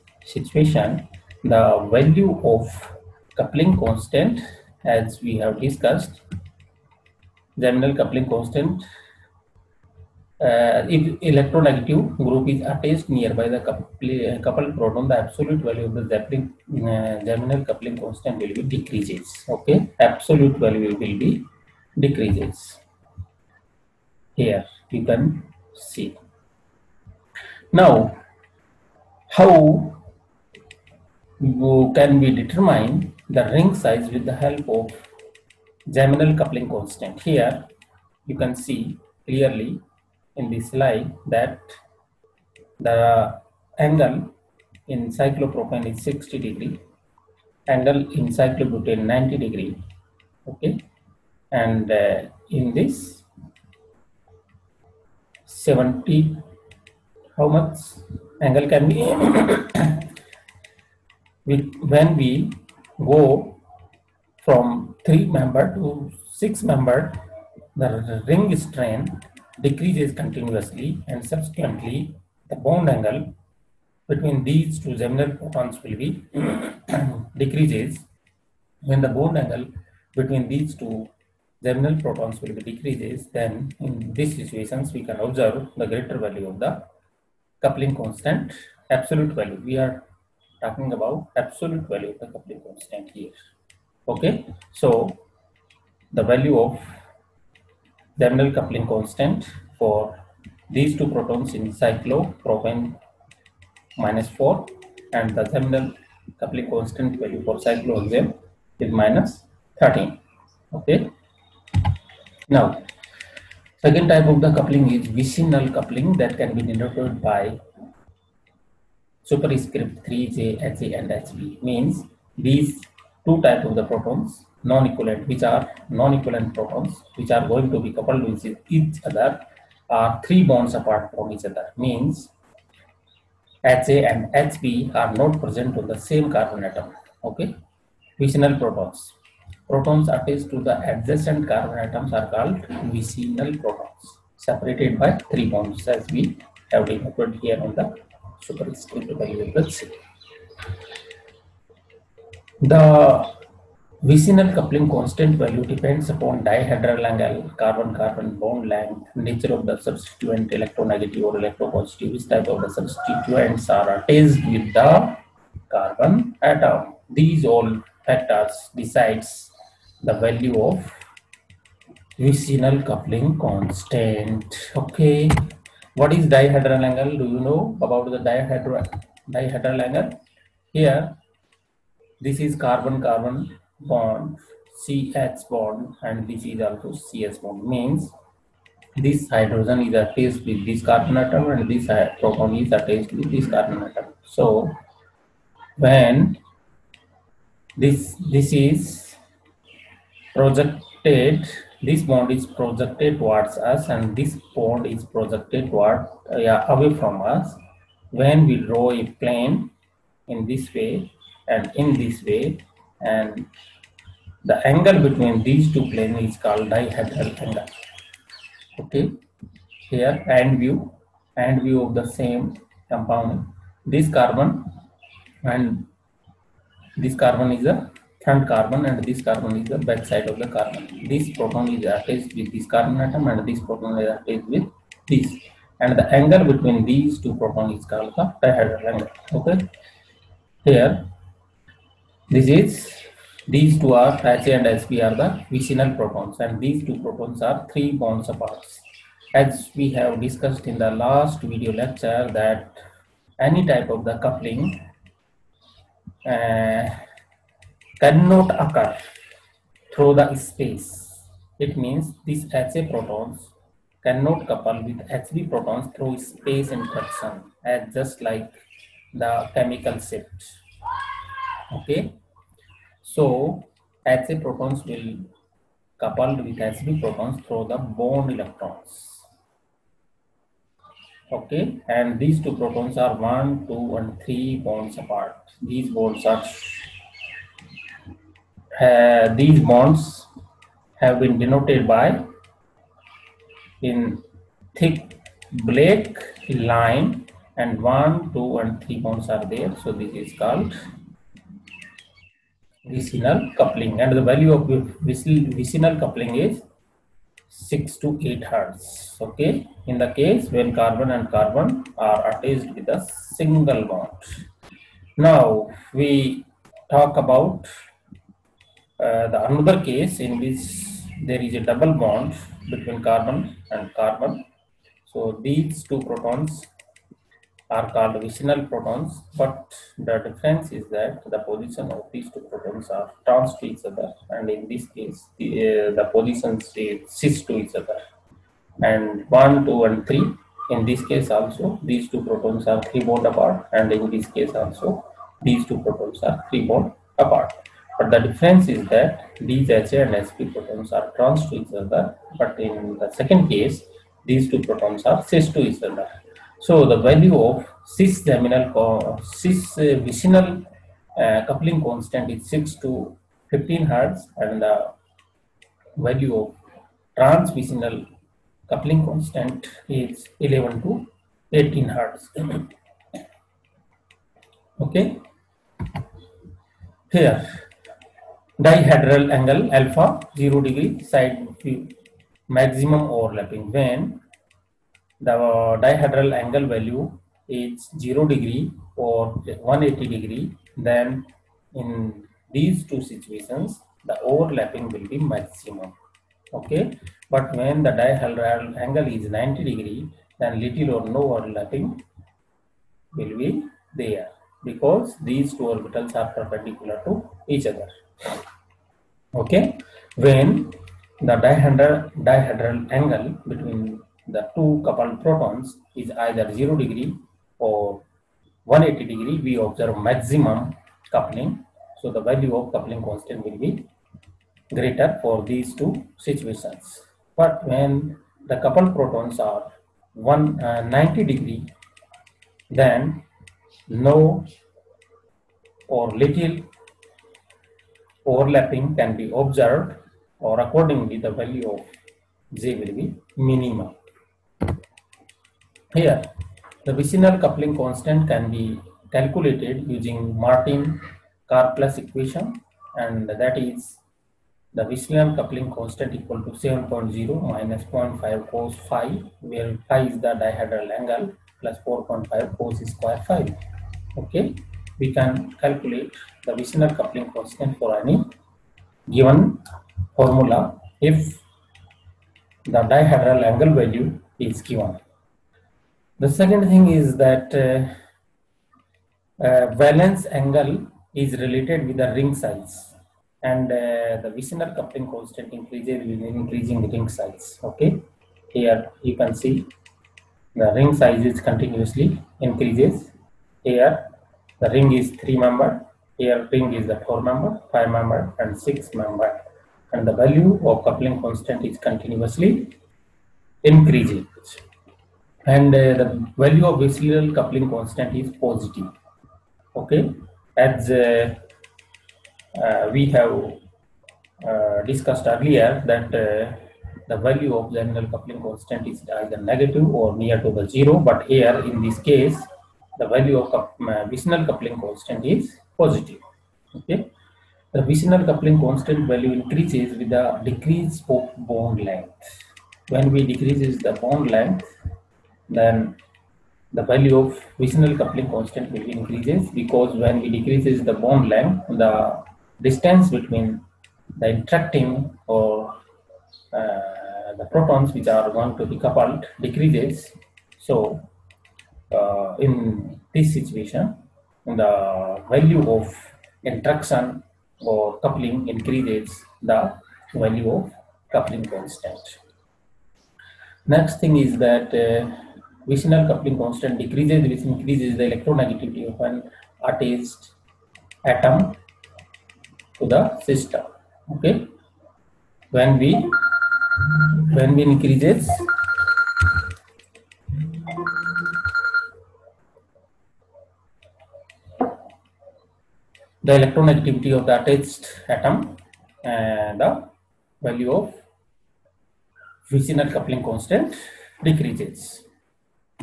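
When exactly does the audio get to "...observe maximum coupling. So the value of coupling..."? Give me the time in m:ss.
6:59.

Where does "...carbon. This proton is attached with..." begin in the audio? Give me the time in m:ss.
3:50.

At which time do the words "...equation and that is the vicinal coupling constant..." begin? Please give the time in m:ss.
7:31.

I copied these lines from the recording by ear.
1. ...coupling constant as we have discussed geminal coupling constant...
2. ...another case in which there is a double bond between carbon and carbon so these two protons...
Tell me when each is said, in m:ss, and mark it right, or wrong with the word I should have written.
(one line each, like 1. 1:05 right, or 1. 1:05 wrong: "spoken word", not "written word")
1. 0:03 right
2. 5:19 right.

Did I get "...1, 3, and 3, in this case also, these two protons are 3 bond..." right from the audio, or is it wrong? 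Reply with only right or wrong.
wrong.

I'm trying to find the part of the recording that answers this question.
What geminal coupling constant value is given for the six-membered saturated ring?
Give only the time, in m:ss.
1:49.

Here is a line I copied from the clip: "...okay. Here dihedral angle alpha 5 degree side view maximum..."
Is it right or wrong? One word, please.
wrong.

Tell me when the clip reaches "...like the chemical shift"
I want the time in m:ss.
4:28.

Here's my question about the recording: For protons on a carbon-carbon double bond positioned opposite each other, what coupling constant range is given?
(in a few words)
11 to 18 Hz.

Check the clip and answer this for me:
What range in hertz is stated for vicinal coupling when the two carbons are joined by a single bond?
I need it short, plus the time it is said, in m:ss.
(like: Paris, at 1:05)
6 to 8 Hz, at 5:07.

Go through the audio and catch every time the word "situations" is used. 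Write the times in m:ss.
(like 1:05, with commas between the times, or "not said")
0:00, 1:24, 6:33, 7:06, 9:13.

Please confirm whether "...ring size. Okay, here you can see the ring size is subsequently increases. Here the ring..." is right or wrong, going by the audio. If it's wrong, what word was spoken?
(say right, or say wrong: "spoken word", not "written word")
wrong: "continuously", not "subsequently".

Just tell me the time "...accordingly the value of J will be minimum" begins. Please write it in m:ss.
7:20.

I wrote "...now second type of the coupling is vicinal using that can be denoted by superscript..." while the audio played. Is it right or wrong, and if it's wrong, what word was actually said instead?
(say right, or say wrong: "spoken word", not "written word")
wrong: "coupling", not "using".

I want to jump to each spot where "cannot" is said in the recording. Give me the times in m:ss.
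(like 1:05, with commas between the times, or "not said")
4:17, 4:24.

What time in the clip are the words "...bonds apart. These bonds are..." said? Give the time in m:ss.
4:44.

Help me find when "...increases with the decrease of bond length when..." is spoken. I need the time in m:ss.
8:49.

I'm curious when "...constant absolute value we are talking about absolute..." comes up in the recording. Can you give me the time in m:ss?
1:27.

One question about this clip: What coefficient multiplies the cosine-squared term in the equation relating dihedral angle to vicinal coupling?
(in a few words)
4.5.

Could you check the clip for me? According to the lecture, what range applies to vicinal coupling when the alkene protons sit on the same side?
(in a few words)
6 to 15 Hz.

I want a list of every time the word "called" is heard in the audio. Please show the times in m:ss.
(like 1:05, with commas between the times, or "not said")
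2:22, 3:36, 3:57, 5:00, 5:27.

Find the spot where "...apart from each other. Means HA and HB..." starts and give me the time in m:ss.
2:10.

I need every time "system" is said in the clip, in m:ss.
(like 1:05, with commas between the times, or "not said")
9:33.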